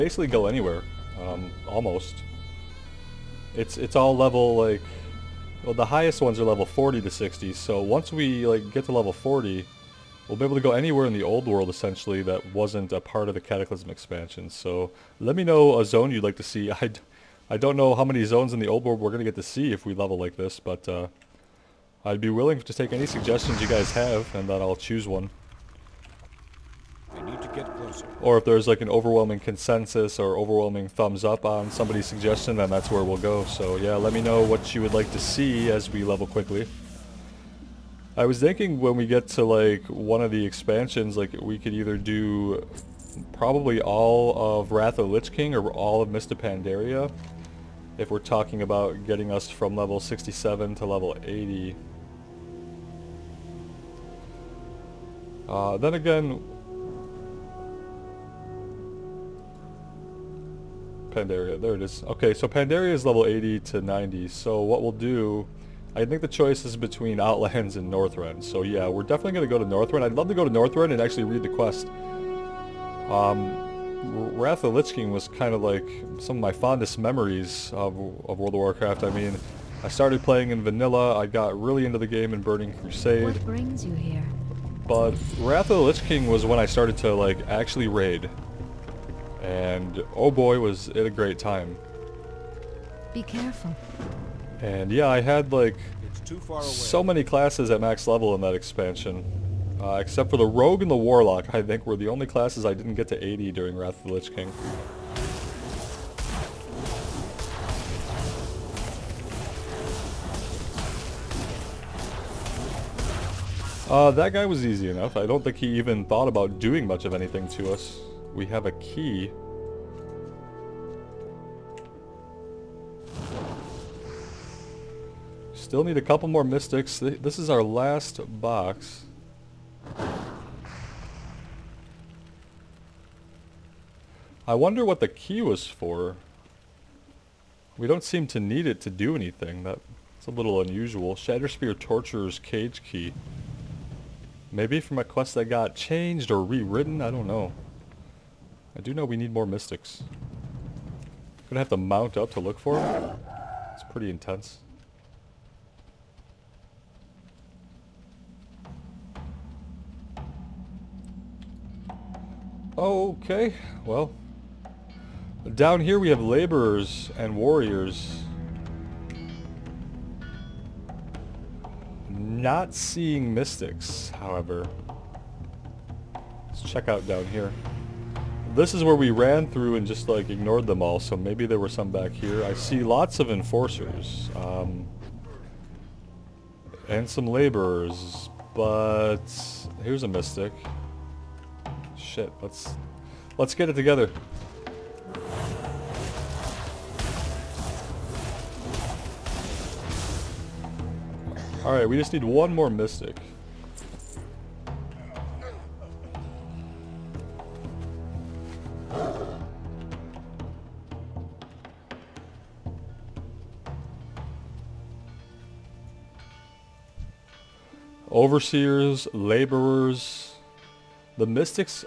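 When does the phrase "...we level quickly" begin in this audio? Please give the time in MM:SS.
00:35.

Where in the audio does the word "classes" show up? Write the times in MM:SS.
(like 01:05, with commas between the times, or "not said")
01:37, 01:42.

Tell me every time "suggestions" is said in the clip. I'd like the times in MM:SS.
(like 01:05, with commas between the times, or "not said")
00:23, 00:32.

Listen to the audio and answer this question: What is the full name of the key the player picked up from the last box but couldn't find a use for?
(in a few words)
Shatterspear Torturer's Cage Key.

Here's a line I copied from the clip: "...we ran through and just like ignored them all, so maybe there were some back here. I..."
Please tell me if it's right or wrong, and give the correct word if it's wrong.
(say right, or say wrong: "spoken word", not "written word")
right.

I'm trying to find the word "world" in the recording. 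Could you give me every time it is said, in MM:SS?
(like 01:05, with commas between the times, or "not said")
00:11, 00:18, 01:18.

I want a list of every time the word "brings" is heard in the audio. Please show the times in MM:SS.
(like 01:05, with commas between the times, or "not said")
01:23.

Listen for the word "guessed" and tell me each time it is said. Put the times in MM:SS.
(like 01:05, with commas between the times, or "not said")
not said.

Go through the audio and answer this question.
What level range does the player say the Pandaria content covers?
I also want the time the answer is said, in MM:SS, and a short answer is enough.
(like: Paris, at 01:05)
80 to 90, at 01:03.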